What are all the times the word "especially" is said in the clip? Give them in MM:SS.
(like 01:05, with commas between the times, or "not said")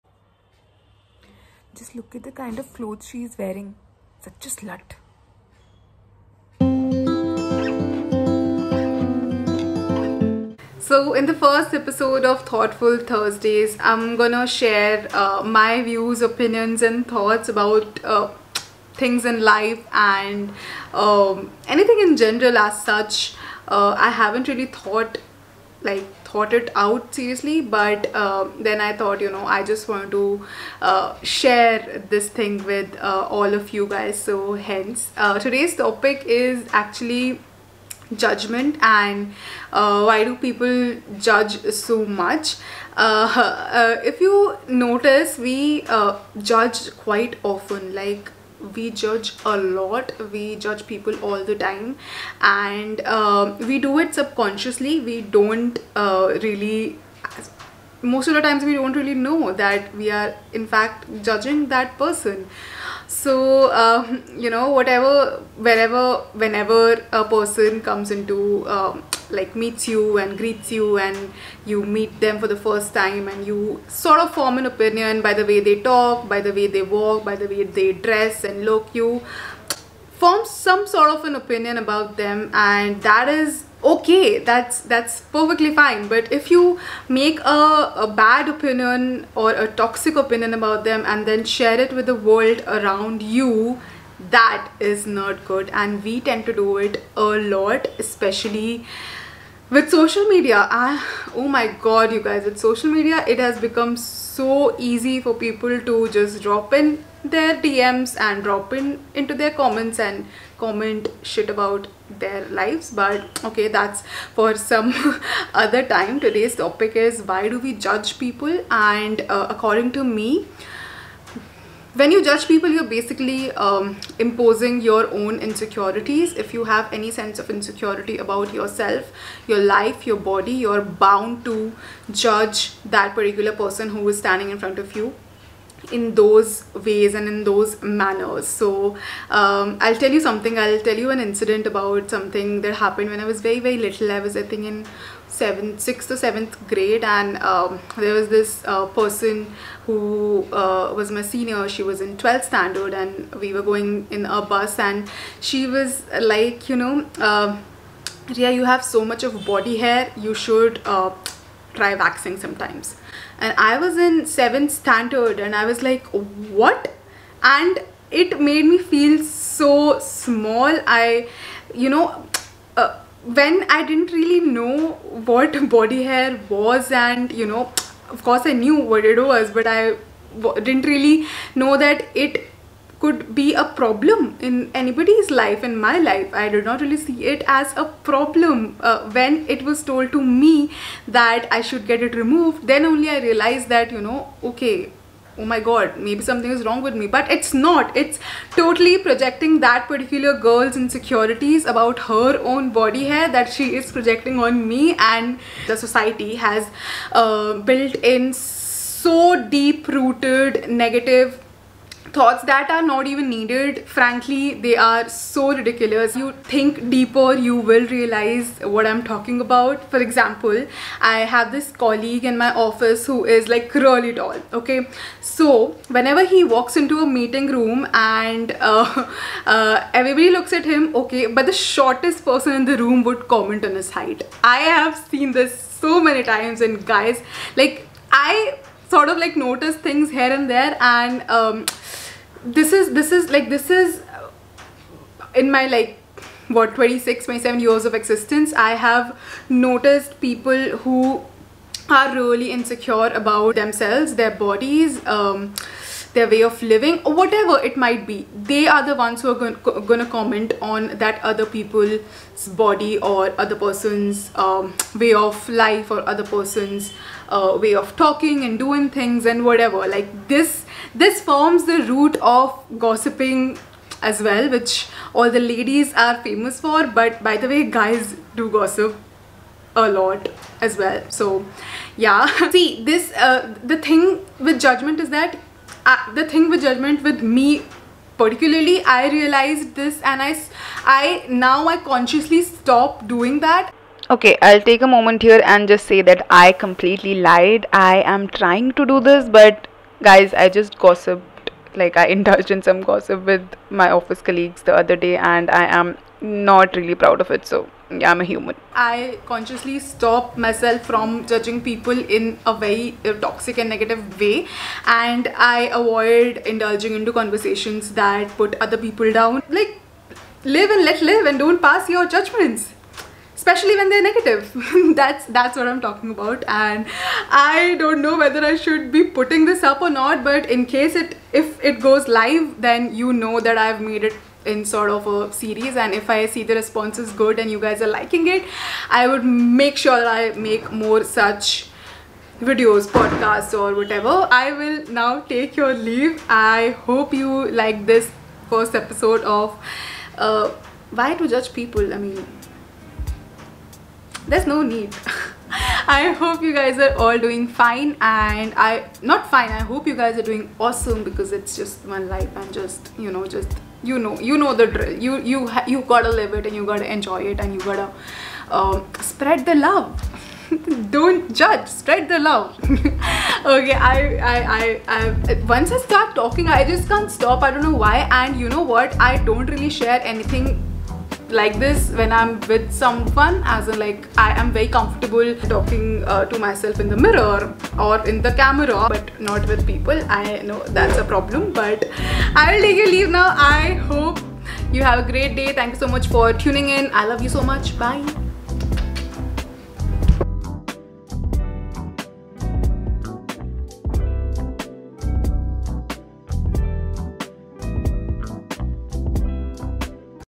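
01:37, 05:23.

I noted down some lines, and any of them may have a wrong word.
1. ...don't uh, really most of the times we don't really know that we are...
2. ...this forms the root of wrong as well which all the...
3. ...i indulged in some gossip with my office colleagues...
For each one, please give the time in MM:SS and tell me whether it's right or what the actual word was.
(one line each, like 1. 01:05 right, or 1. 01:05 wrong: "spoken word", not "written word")
1. 00:55 right
2. 04:30 wrong: "gossiping", not "wrong"
3. 05:01 right.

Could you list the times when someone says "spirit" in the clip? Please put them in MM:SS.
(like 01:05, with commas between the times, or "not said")
not said.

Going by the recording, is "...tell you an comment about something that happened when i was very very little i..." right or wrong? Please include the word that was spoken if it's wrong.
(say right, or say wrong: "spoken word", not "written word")
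wrong: "incident", not "comment".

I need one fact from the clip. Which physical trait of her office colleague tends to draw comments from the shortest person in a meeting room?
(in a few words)
Really tall.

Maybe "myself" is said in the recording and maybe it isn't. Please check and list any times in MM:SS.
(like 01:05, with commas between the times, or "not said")
05:10, 06:26.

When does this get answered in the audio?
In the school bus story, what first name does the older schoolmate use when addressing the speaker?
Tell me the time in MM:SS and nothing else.
02:38.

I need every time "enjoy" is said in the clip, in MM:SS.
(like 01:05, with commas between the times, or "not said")
06:06.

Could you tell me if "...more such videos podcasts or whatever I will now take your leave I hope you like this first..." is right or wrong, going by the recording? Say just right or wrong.
right.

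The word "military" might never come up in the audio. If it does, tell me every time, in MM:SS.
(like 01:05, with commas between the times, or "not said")
not said.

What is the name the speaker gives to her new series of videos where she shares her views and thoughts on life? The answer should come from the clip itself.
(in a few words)
Thoughtful Thursdays.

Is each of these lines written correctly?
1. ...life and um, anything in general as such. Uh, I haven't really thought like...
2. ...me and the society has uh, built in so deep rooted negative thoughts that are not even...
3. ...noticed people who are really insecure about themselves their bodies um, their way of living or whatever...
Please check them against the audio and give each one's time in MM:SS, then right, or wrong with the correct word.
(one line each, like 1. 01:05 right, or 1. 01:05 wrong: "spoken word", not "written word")
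1. 00:19 right
2. 03:24 right
3. 04:09 right.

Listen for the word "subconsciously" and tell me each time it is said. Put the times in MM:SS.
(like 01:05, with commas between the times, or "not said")
00:54.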